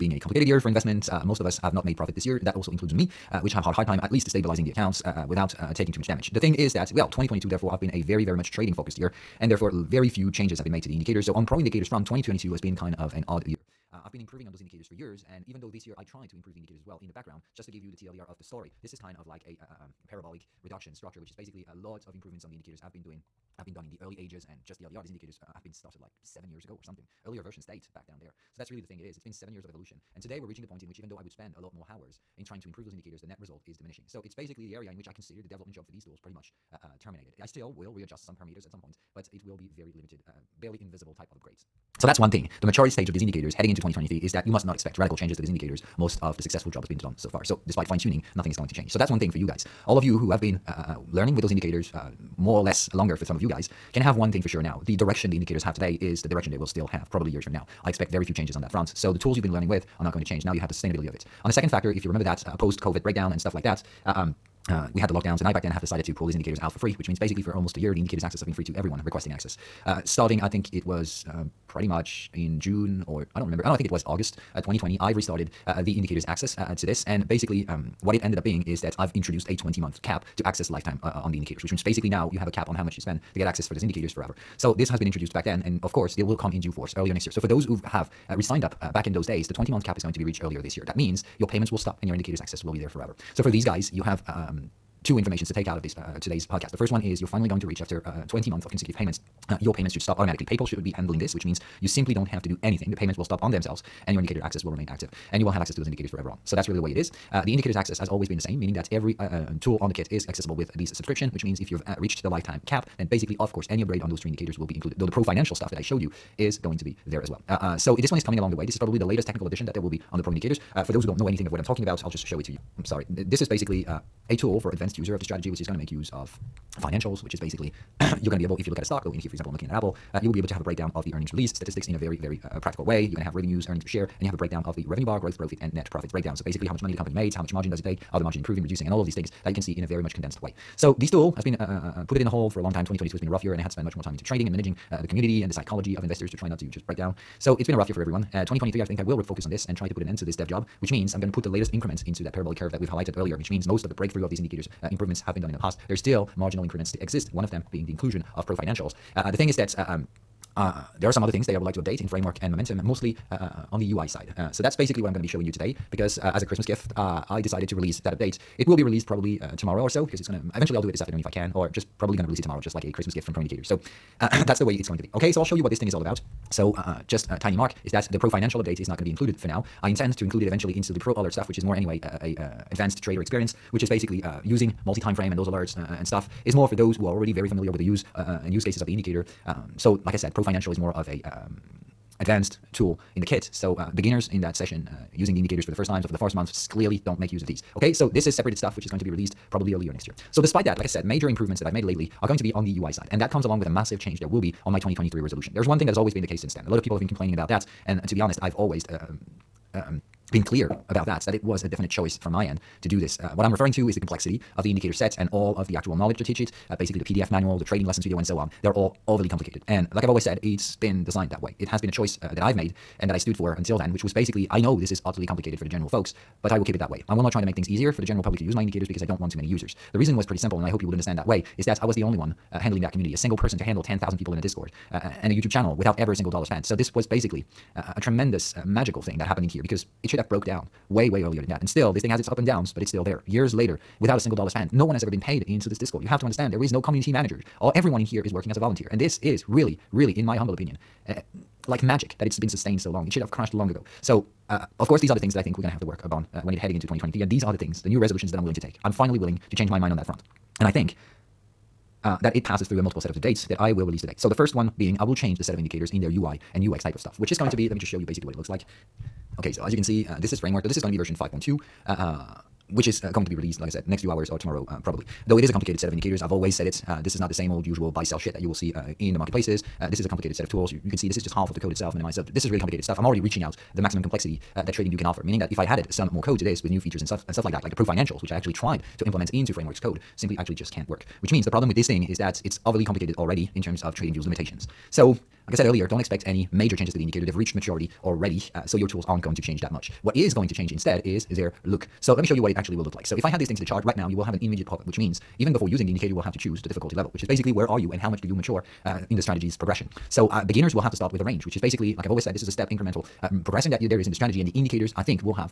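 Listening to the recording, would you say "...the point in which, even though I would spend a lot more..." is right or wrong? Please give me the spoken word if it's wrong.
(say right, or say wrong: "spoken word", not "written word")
right.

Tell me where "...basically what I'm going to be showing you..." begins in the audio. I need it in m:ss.
2:44.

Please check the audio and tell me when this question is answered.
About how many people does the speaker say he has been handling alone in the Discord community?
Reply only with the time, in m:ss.
3:53.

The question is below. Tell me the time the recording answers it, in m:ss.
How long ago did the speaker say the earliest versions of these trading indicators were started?
0:26.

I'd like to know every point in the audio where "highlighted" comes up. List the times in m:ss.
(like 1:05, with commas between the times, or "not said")
2:32.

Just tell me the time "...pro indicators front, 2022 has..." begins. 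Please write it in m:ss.
0:11.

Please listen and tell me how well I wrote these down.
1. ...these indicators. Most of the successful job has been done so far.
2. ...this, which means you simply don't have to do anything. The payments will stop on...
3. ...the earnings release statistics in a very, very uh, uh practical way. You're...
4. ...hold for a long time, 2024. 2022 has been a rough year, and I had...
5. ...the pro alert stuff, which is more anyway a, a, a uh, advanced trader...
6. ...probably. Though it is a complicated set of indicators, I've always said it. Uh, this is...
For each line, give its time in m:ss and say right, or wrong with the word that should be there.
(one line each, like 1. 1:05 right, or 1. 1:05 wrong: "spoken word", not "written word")
1. 0:45 right
2. 1:41 right
3. 2:11 right
4. 2:22 wrong: "2020", not "2024"
5. 3:00 right
6. 4:34 right.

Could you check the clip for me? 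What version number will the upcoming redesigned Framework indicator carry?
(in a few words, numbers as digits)
5.2.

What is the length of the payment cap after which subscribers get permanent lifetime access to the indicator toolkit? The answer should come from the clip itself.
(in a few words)
20 months.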